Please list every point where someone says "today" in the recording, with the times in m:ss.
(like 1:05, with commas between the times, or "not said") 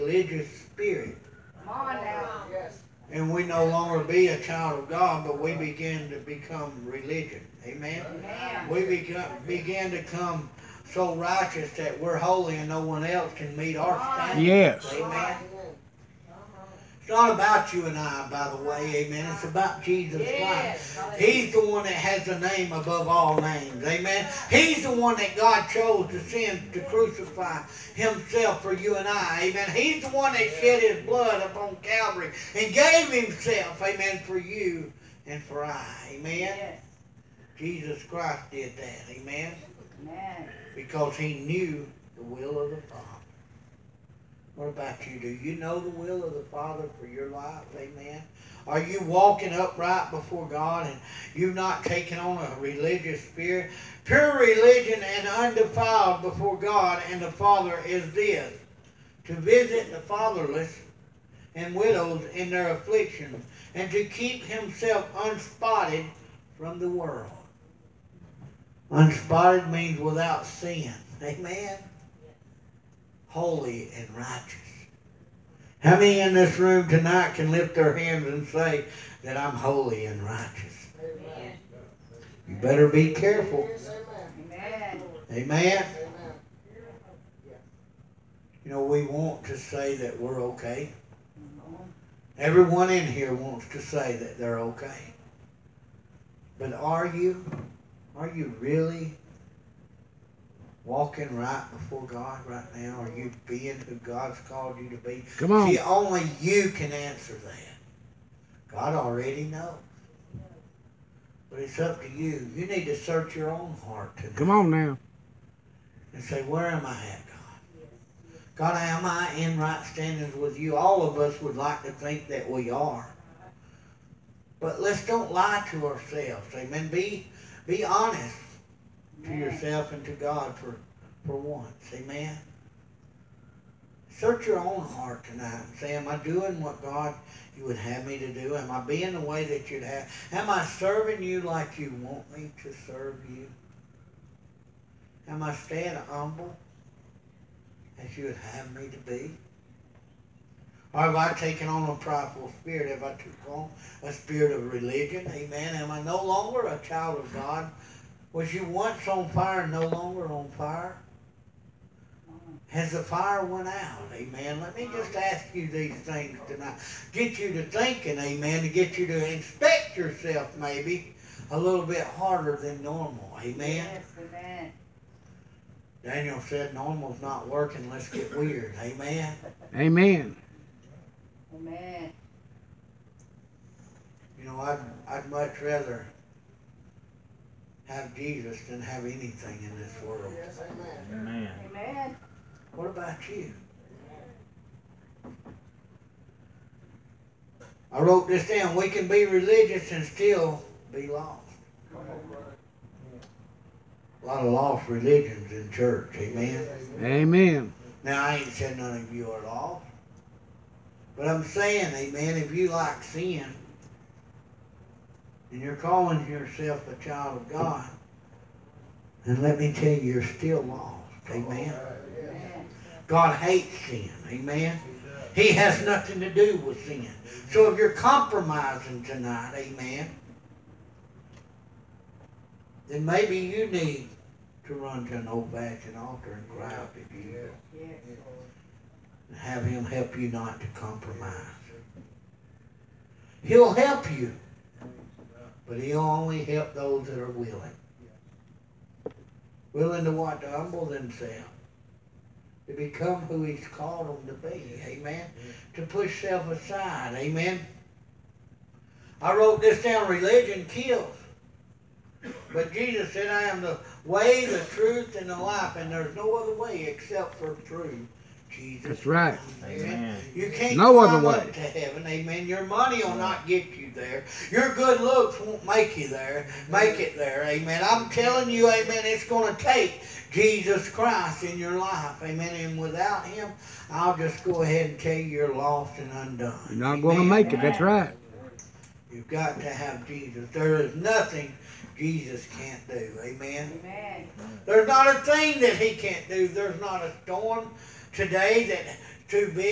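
1:54, 4:58.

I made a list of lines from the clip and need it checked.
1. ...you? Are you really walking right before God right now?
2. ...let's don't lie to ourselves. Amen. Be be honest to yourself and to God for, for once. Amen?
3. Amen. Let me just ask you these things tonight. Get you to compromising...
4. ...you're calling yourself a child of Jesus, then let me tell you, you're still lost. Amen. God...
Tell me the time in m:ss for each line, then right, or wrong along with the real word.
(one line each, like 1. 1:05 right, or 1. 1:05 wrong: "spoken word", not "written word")
1. 1:37 right
2. 2:04 right
3. 2:44 wrong: "thinking", not "compromising"
4. 3:35 wrong: "God", not "Jesus".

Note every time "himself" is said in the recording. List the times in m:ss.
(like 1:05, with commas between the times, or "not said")
0:27, 0:33, 1:04.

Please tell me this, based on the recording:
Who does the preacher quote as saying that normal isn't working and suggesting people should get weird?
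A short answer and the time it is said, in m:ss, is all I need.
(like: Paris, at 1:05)
Daniel, at 2:56.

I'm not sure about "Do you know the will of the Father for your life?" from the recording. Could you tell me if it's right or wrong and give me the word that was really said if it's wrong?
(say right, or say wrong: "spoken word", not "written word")
right.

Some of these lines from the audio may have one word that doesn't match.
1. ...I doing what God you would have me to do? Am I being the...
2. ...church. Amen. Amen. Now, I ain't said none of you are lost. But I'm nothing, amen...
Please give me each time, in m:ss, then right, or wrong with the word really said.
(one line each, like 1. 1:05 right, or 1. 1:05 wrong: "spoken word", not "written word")
1. 2:16 right
2. 3:25 wrong: "saying", not "nothing".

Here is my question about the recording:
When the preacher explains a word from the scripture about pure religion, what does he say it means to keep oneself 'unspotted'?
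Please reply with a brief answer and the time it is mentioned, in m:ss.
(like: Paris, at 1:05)
without sin, at 1:09.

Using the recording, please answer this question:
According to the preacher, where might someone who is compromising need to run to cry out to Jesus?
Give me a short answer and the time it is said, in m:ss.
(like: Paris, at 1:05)
an old-fashioned altar, at 3:55.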